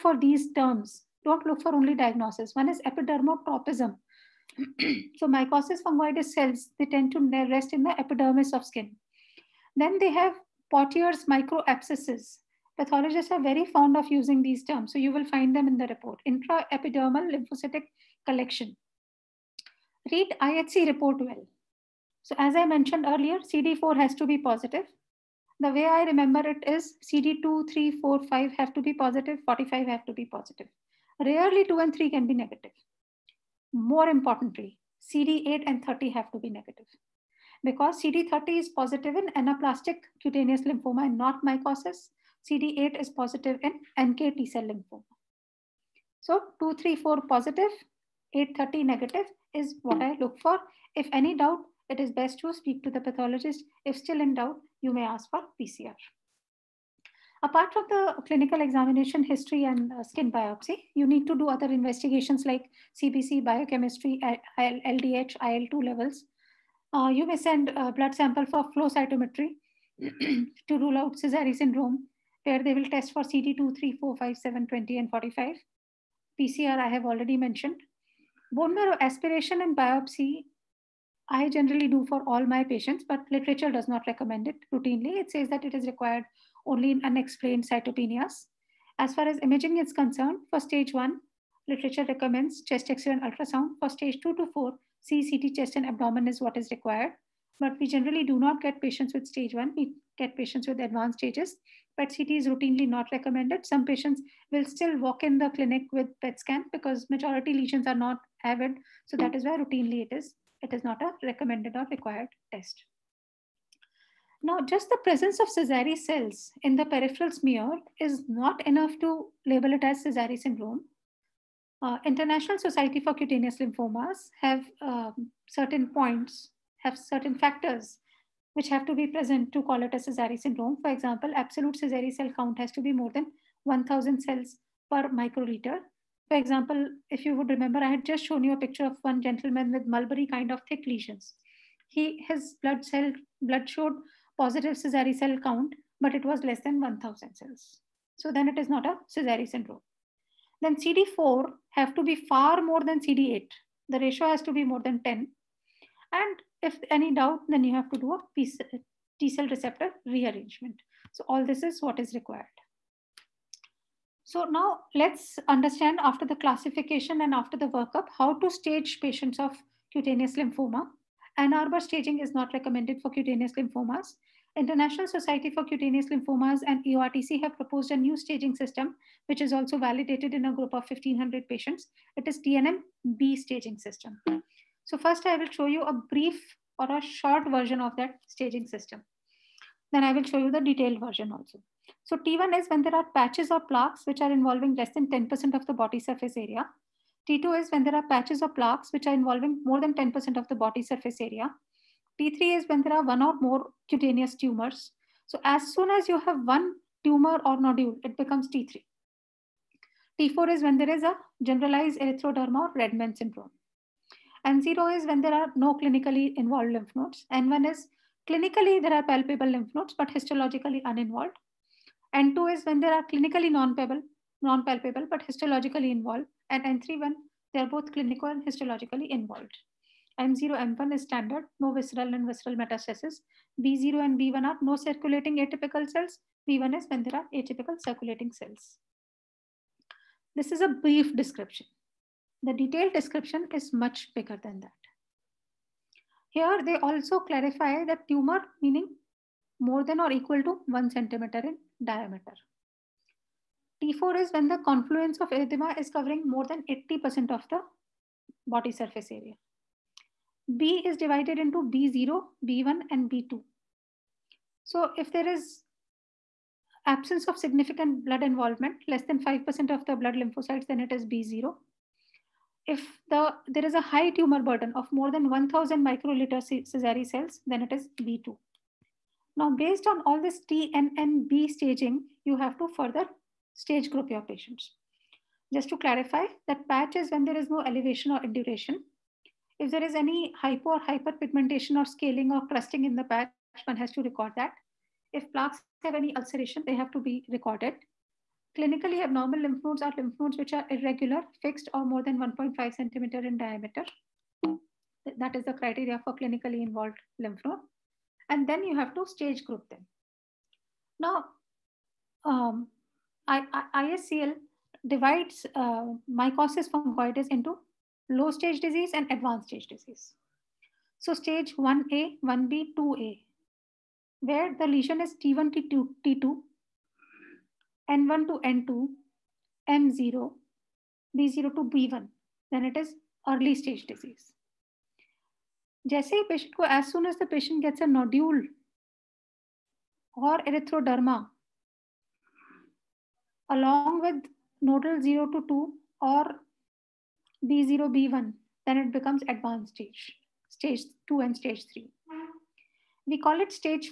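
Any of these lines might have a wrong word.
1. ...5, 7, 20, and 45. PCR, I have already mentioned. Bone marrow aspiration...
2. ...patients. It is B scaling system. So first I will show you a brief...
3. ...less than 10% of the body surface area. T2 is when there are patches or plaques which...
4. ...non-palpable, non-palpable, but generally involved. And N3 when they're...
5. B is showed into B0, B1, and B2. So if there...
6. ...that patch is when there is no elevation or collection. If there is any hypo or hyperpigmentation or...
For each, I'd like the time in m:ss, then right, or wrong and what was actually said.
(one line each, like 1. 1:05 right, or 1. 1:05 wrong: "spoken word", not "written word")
1. 1:14 right
2. 3:01 wrong: "staging", not "scaling"
3. 3:14 right
4. 3:43 wrong: "histologically", not "generally"
5. 4:20 wrong: "divided", not "showed"
6. 4:46 wrong: "induration", not "collection".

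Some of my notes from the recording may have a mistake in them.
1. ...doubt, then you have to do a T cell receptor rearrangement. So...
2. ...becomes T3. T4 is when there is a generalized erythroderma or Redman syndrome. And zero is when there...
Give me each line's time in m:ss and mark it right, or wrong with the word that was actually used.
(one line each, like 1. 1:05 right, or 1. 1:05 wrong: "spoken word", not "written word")
1. 2:37 right
2. 3:28 right.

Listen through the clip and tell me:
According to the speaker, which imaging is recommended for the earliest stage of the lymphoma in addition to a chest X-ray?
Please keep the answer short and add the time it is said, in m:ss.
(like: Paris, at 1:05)
ultrasound, at 1:33.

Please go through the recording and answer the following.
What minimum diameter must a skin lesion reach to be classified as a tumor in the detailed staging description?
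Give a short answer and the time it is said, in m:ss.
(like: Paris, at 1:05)
1 centimeter, at 4:10.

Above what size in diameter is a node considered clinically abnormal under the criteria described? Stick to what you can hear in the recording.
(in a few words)
1.5 centimeters.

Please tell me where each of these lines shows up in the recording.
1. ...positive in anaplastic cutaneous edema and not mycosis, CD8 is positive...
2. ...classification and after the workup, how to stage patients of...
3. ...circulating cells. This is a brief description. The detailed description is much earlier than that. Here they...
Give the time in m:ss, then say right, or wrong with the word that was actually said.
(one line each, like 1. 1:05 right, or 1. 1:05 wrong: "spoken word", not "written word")
1. 0:38 wrong: "lymphoma", not "edema"
2. 2:46 right
3. 3:57 wrong: "bigger", not "earlier".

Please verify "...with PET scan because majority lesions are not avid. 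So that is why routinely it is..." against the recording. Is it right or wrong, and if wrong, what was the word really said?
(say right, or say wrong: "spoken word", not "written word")
right.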